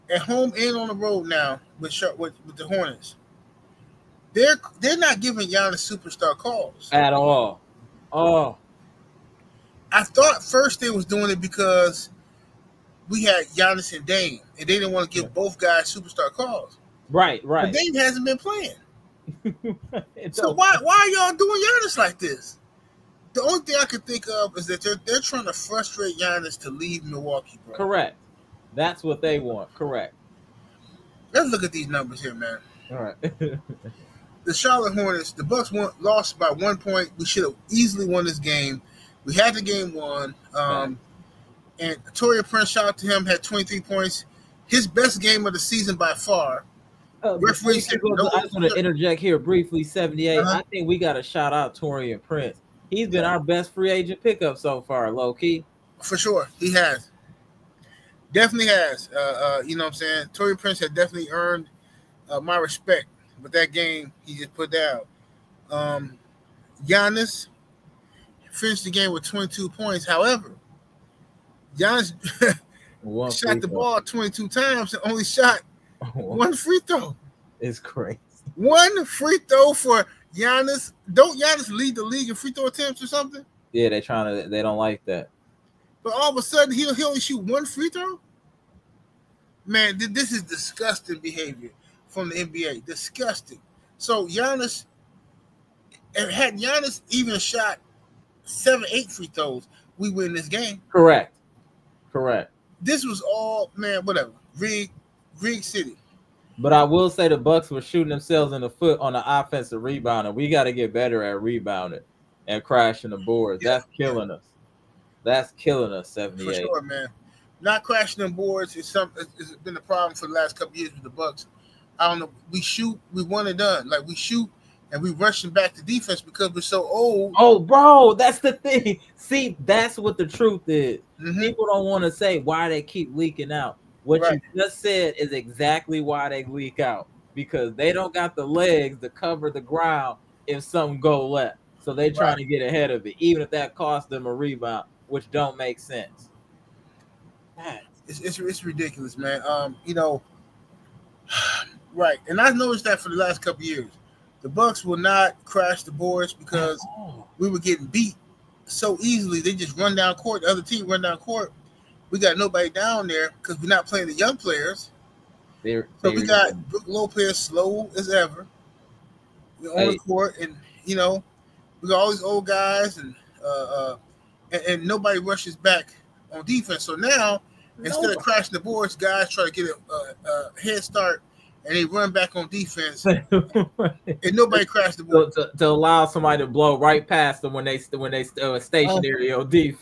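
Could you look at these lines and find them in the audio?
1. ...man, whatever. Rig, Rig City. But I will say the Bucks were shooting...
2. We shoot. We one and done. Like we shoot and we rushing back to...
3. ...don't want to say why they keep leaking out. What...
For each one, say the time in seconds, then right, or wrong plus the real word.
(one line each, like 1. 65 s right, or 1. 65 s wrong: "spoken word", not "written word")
1. 103 s right
2. 122 s right
3. 131 s right.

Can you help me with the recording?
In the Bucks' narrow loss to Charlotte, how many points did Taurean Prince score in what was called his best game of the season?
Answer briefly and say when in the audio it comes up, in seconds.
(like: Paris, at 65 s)
23, at 43 s.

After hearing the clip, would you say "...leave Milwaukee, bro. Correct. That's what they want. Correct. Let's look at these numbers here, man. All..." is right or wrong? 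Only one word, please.
right.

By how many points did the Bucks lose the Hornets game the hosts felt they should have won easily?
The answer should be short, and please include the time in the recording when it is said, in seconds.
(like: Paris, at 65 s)
1 point, at 36 s.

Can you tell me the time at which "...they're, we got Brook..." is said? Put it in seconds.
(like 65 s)
166 s.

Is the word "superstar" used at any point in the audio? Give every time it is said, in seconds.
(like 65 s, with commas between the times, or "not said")
5 s, 15 s.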